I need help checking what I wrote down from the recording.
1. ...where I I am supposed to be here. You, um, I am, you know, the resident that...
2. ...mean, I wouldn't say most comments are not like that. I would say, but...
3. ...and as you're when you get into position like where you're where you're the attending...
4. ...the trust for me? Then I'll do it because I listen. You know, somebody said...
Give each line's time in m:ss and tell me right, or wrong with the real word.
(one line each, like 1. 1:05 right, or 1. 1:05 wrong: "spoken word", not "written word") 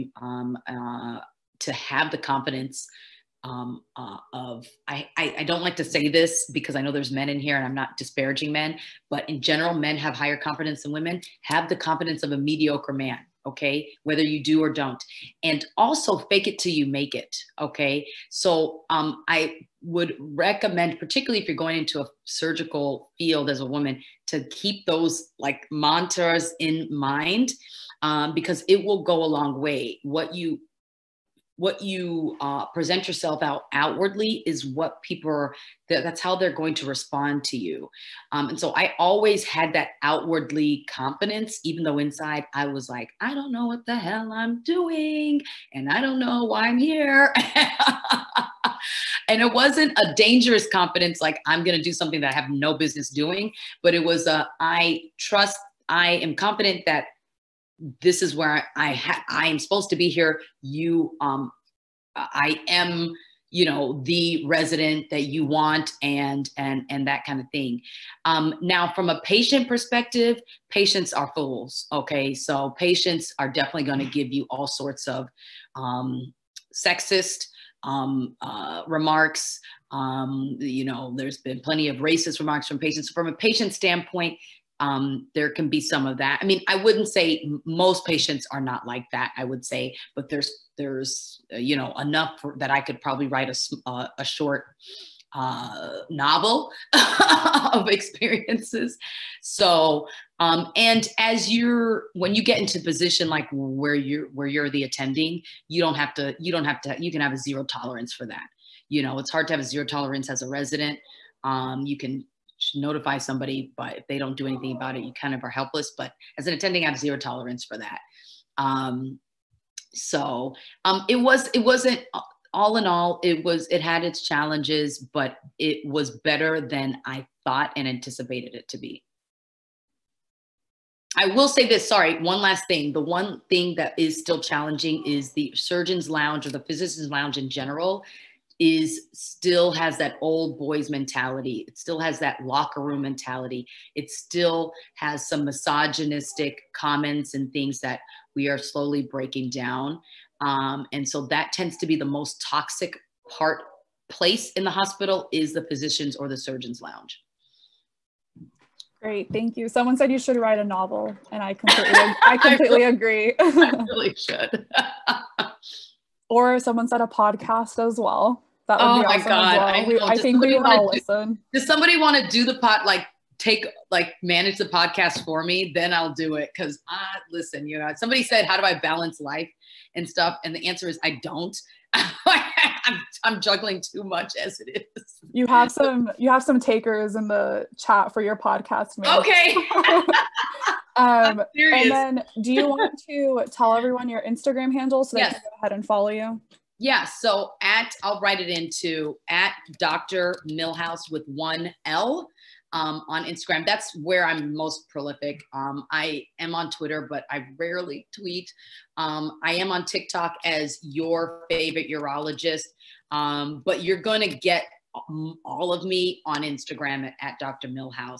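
1. 0:58 right
2. 1:26 wrong: "patients", not "comments"
3. 1:40 right
4. 2:54 wrong: "podcast", not "trust".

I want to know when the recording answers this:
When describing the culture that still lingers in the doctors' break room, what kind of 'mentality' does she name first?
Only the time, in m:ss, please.
2:20.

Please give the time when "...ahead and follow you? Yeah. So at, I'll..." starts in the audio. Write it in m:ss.
3:15.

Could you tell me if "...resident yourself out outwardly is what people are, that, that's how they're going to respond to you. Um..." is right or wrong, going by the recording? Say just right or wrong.
wrong.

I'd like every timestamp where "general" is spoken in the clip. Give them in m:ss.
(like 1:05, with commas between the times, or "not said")
0:09, 2:17.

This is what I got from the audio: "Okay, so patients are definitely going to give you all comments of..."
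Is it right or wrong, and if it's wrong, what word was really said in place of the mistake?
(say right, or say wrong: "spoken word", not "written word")
wrong: "sorts", not "comments".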